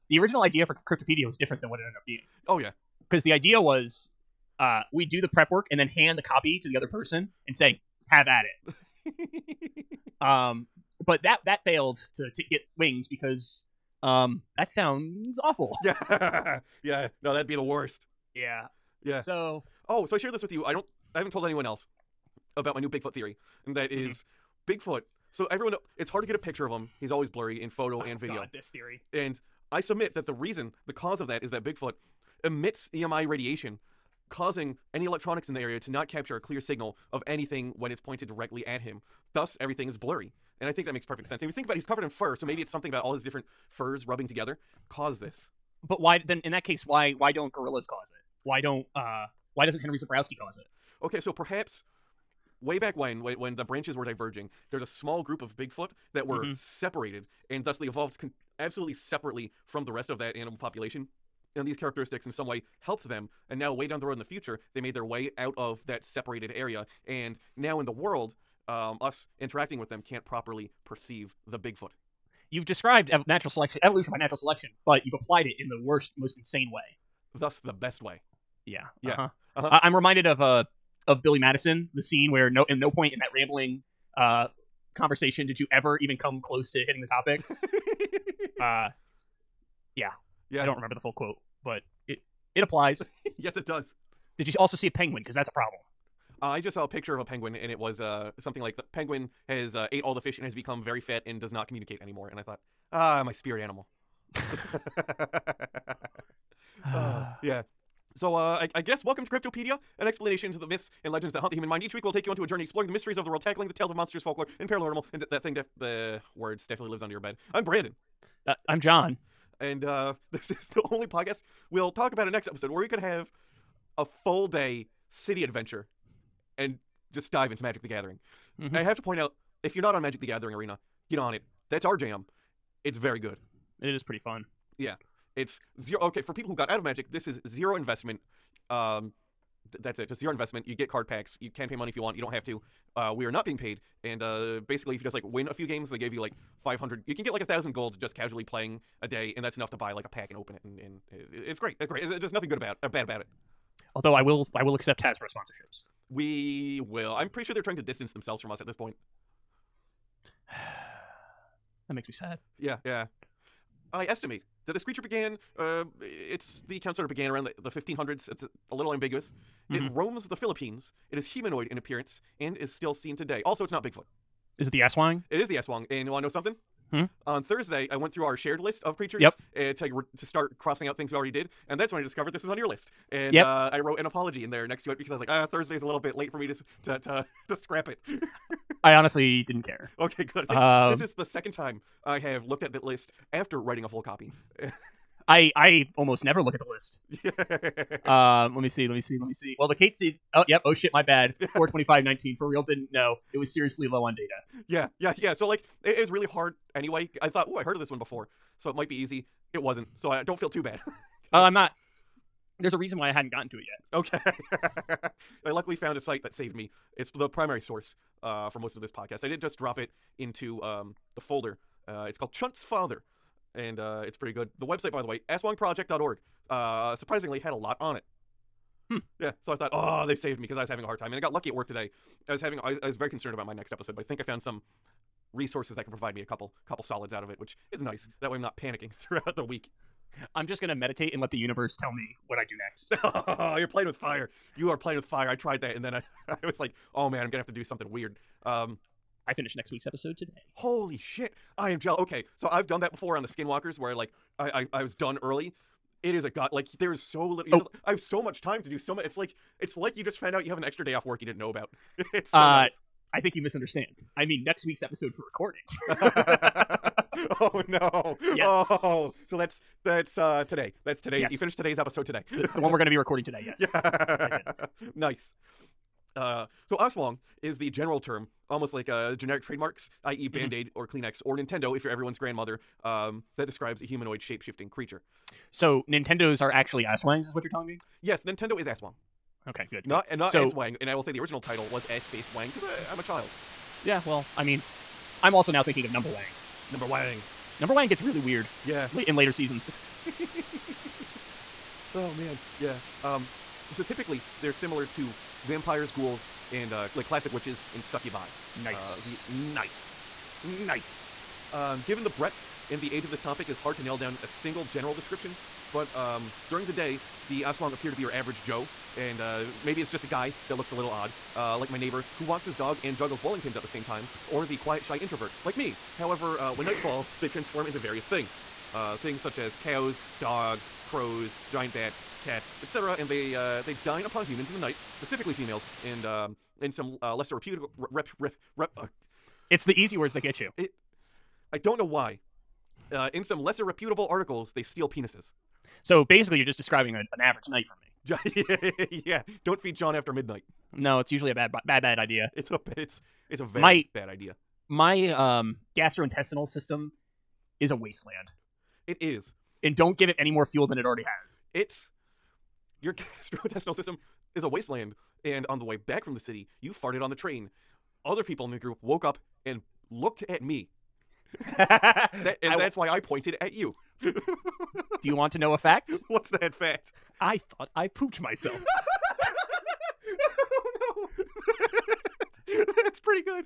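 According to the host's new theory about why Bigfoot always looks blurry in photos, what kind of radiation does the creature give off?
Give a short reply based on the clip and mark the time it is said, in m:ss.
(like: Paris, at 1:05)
EMI radiation, at 0:32.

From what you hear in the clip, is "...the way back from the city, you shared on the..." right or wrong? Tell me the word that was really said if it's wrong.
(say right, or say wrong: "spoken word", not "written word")
wrong: "farted", not "shared".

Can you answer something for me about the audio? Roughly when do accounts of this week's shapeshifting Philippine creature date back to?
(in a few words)
1500s.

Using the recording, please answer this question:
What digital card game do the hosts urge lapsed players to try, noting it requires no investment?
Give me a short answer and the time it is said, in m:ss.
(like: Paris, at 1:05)
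Magic the Gathering Arena, at 2:10.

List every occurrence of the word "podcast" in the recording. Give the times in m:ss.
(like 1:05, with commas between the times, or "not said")
2:01, 3:38.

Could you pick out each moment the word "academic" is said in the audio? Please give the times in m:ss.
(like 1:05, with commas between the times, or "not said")
not said.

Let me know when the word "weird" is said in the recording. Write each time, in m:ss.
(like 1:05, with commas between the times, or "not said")
4:07, 4:58.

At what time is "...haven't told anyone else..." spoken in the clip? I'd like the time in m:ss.
0:21.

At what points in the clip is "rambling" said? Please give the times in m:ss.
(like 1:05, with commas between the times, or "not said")
1:23.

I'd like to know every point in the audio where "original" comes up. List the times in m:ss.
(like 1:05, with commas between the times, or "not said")
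0:00, 4:51.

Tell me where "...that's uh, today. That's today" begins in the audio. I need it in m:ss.
4:29.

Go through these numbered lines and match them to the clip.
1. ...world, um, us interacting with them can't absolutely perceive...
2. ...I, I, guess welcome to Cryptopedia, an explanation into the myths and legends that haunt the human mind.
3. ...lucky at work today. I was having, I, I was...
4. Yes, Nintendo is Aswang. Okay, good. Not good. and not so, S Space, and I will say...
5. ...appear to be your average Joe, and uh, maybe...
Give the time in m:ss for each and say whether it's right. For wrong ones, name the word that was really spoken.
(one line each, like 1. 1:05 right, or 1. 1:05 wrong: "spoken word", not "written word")
1. 1:07 wrong: "properly", not "absolutely"
2. 1:48 right
3. 3:51 right
4. 4:48 wrong: "Wang", not "Space"
5. 5:17 right.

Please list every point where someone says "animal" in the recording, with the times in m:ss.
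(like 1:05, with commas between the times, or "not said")
1:00, 1:43.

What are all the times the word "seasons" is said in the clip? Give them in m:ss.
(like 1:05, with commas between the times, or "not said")
4:59.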